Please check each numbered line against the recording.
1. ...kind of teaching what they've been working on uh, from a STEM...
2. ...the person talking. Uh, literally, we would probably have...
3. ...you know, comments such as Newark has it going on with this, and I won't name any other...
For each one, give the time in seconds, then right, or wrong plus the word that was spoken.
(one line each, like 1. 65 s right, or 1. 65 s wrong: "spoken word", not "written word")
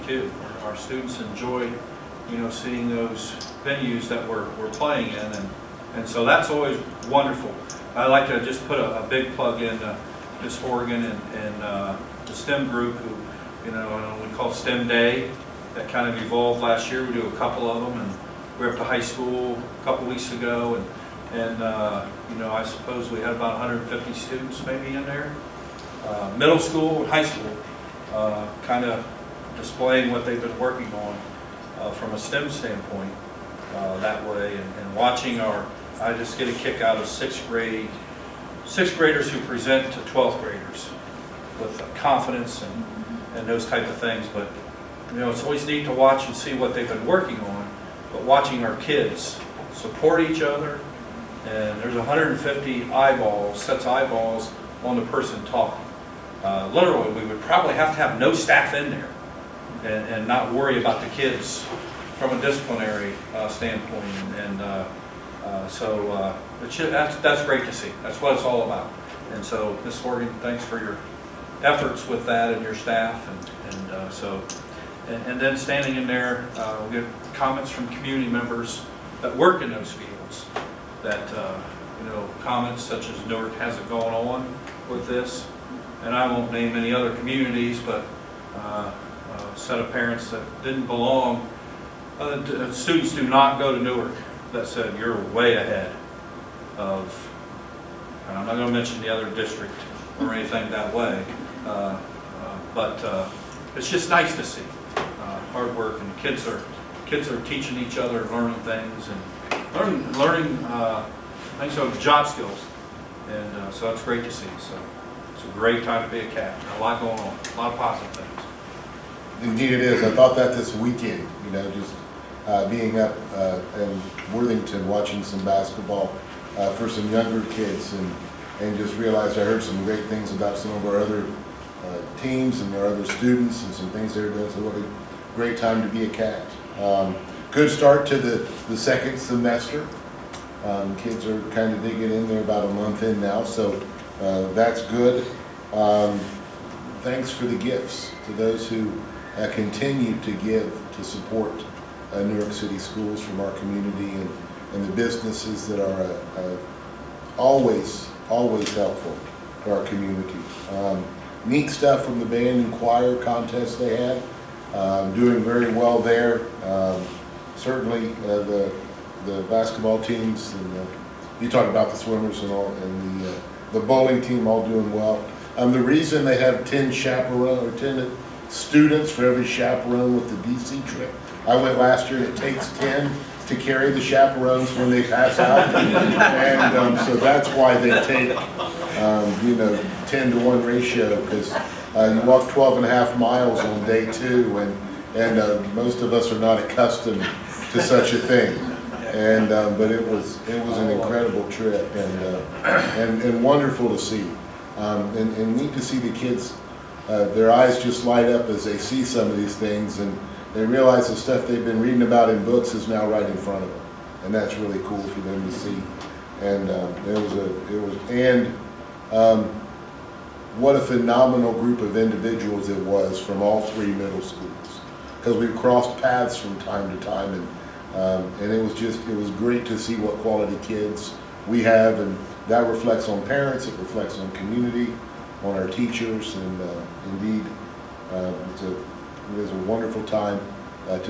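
1. 28 s wrong: "displaying", not "teaching"
2. 54 s right
3. 81 s right.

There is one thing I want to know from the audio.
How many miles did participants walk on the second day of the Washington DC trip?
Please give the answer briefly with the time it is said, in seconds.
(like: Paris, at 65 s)
12.5 miles, at 192 s.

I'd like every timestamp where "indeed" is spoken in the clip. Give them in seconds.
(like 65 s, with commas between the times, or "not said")
119 s, 237 s.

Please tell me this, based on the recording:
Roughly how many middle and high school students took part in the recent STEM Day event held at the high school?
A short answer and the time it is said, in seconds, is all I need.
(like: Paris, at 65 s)
150, at 23 s.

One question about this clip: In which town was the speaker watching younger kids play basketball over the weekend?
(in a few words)
Worthington.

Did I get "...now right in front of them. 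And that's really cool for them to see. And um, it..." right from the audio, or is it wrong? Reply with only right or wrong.
right.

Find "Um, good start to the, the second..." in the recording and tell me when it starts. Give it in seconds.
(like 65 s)
136 s.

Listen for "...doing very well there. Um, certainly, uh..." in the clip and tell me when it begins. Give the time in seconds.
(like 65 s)
165 s.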